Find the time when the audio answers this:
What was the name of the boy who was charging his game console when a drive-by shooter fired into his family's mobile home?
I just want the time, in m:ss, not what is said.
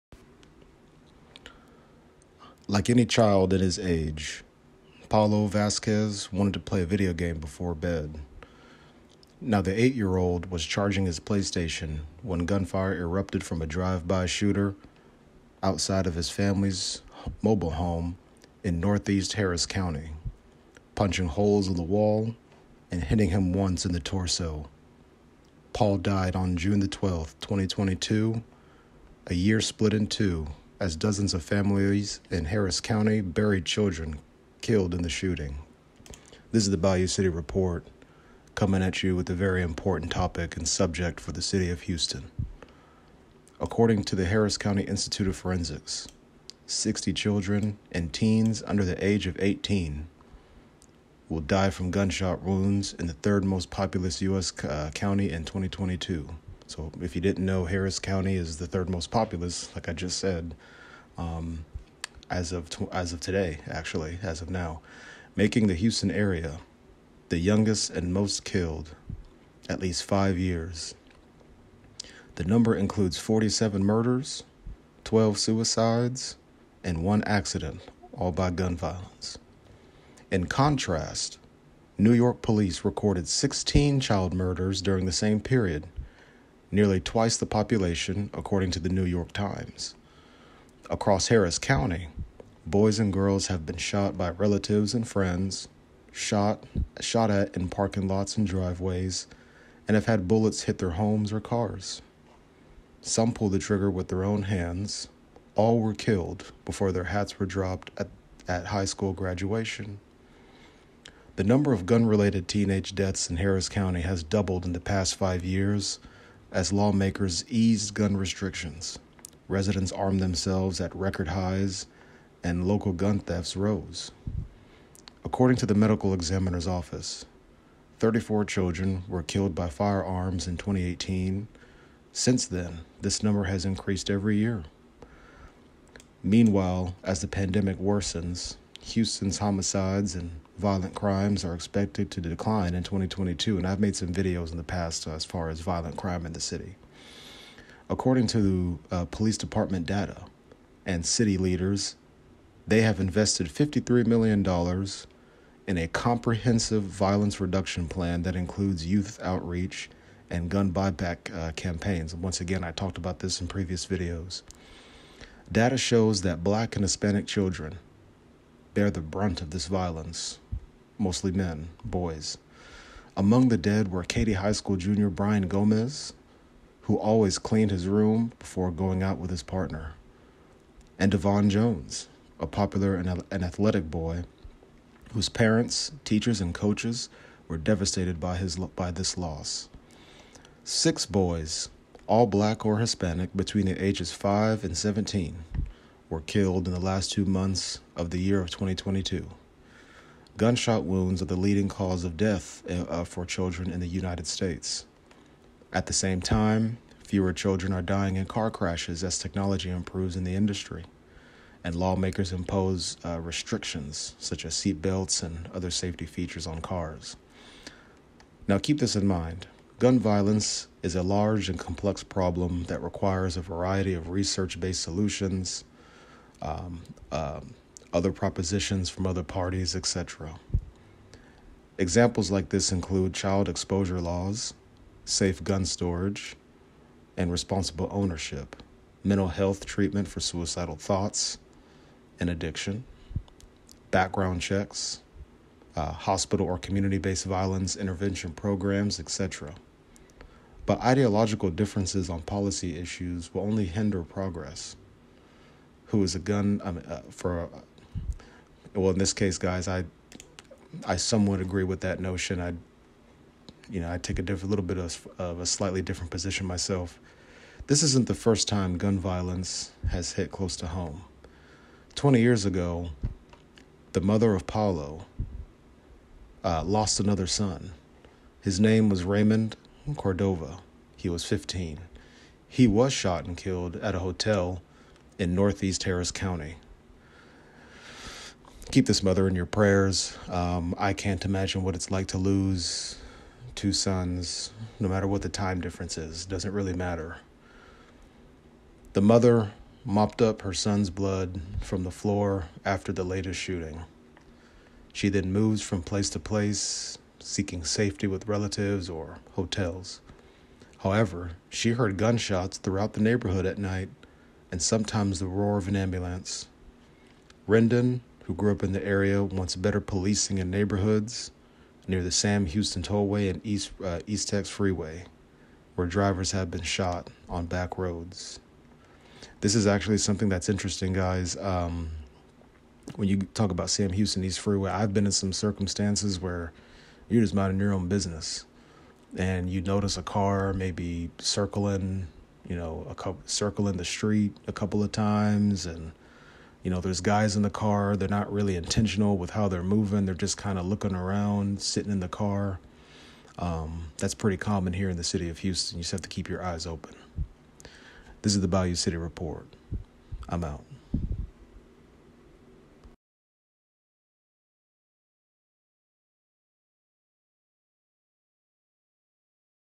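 0:05.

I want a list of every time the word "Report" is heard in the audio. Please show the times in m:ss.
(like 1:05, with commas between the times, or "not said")
0:37, 5:58.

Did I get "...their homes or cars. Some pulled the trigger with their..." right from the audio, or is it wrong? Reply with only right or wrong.
right.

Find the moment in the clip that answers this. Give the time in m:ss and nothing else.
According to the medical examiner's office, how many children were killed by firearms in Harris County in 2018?
2:07.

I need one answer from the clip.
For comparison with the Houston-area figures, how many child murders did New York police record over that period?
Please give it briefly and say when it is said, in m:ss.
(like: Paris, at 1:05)
16, at 1:23.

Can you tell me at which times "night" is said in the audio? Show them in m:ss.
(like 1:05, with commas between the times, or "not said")
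5:13.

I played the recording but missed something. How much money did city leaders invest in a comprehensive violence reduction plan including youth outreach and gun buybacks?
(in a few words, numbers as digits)
$53 million.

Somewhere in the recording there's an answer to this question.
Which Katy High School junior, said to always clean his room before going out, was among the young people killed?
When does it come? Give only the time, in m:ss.
2:55.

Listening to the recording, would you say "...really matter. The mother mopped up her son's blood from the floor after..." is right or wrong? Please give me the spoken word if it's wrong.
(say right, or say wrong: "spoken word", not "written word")
right.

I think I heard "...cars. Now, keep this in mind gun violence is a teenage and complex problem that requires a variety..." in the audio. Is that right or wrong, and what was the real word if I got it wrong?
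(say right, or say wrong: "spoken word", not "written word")
wrong: "large", not "teenage".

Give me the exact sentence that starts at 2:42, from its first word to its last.
Once again, I talked about this in previous videos.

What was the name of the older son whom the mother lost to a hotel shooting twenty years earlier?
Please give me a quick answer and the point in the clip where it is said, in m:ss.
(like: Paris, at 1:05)
Raymond Cordova, at 4:39.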